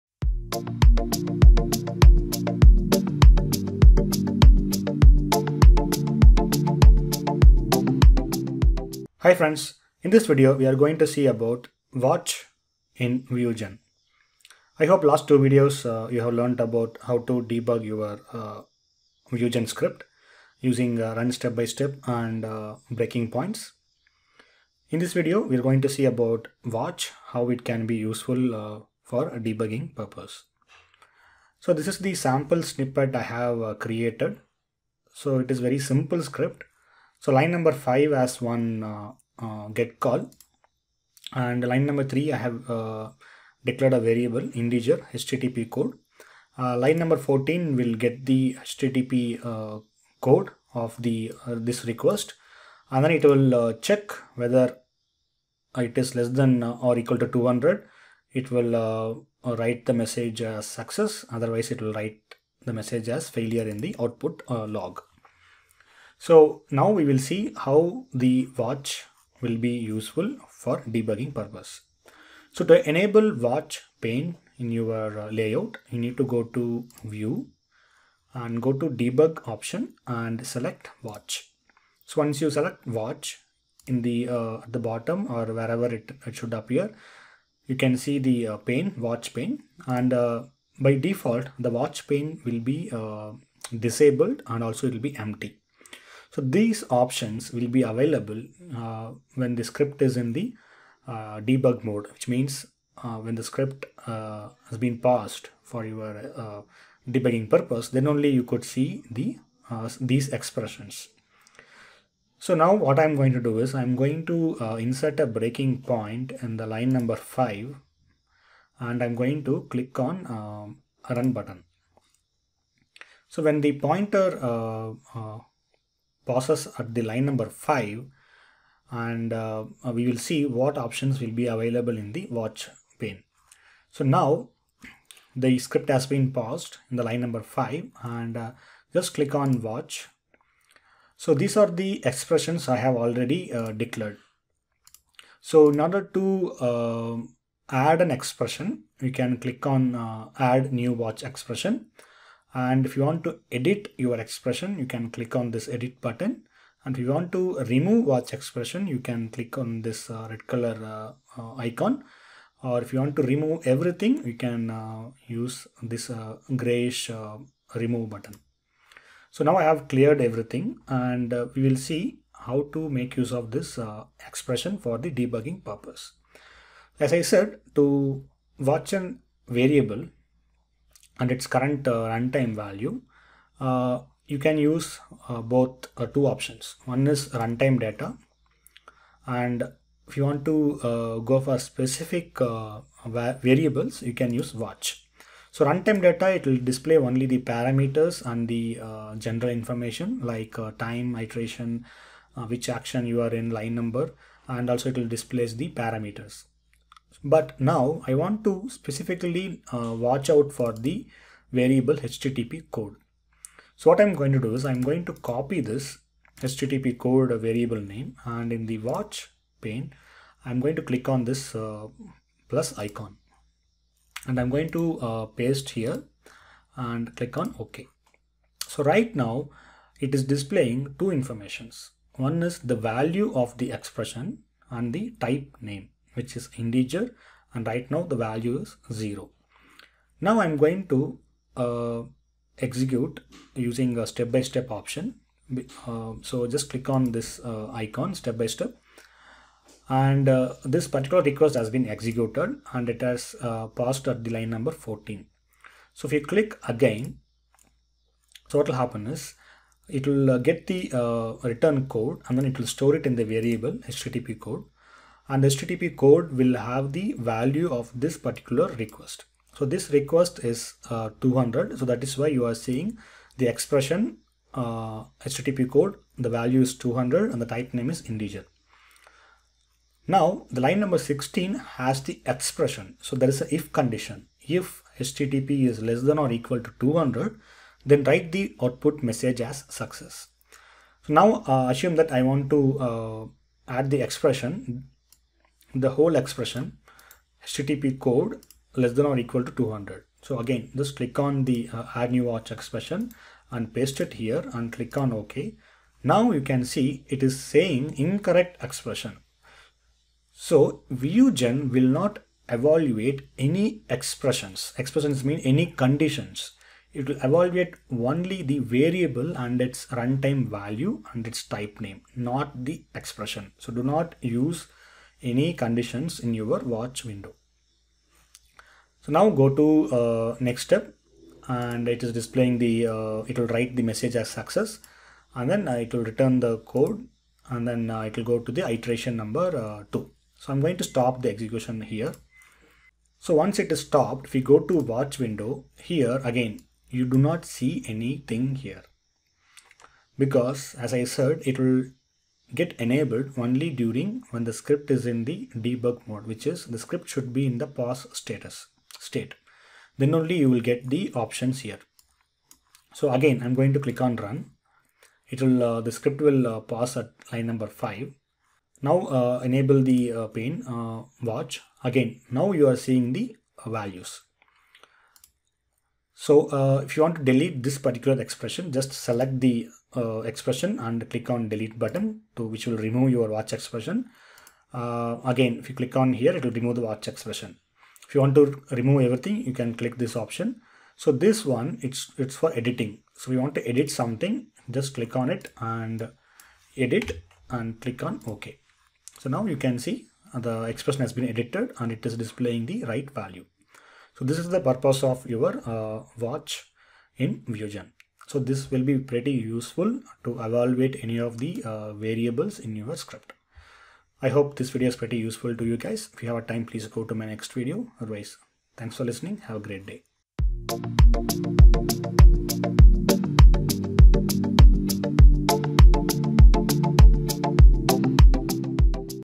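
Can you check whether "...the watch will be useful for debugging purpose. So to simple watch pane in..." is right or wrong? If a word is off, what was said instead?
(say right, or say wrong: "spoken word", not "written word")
wrong: "enable", not "simple".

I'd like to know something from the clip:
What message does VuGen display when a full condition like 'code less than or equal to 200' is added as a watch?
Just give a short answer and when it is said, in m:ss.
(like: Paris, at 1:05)
incorrect expression, at 5:07.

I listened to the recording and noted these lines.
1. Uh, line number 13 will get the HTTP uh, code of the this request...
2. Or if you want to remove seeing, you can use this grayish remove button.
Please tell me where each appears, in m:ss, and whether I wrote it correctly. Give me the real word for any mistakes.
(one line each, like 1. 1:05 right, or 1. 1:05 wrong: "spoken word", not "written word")
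1. 0:46 wrong: "14", not "13"
2. 2:42 wrong: "everything", not "seeing".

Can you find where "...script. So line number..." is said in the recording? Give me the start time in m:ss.
0:36.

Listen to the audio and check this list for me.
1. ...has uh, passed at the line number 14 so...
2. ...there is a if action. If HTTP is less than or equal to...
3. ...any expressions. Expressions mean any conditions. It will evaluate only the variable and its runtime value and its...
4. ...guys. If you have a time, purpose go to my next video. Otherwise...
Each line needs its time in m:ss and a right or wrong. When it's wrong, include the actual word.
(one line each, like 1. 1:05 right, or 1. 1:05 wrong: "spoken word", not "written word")
1. 4:13 right
2. 4:43 wrong: "condition", not "action"
3. 5:13 right
4. 6:55 wrong: "please", not "purpose".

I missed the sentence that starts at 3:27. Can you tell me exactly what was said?
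But now I want to specifically uh, watch out for the variable HTTP code.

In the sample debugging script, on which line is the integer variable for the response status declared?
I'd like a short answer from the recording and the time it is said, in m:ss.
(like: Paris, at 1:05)
3, at 0:41.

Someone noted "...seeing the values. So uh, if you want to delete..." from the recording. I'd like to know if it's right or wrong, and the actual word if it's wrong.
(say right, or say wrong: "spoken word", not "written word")
right.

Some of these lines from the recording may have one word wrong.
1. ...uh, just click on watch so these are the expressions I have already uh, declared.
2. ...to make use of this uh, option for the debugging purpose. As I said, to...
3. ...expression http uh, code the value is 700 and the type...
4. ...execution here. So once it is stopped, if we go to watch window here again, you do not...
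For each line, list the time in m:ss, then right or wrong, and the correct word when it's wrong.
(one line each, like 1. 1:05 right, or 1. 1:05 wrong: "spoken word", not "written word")
1. 2:18 right
2. 2:52 wrong: "expression", not "option"
3. 4:33 wrong: "200", not "700"
4. 5:41 right.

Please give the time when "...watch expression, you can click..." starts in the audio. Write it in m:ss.
2:38.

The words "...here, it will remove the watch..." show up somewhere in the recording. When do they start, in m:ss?
6:26.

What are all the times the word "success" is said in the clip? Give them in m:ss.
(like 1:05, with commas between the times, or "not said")
1:00, 4:49, 5:34.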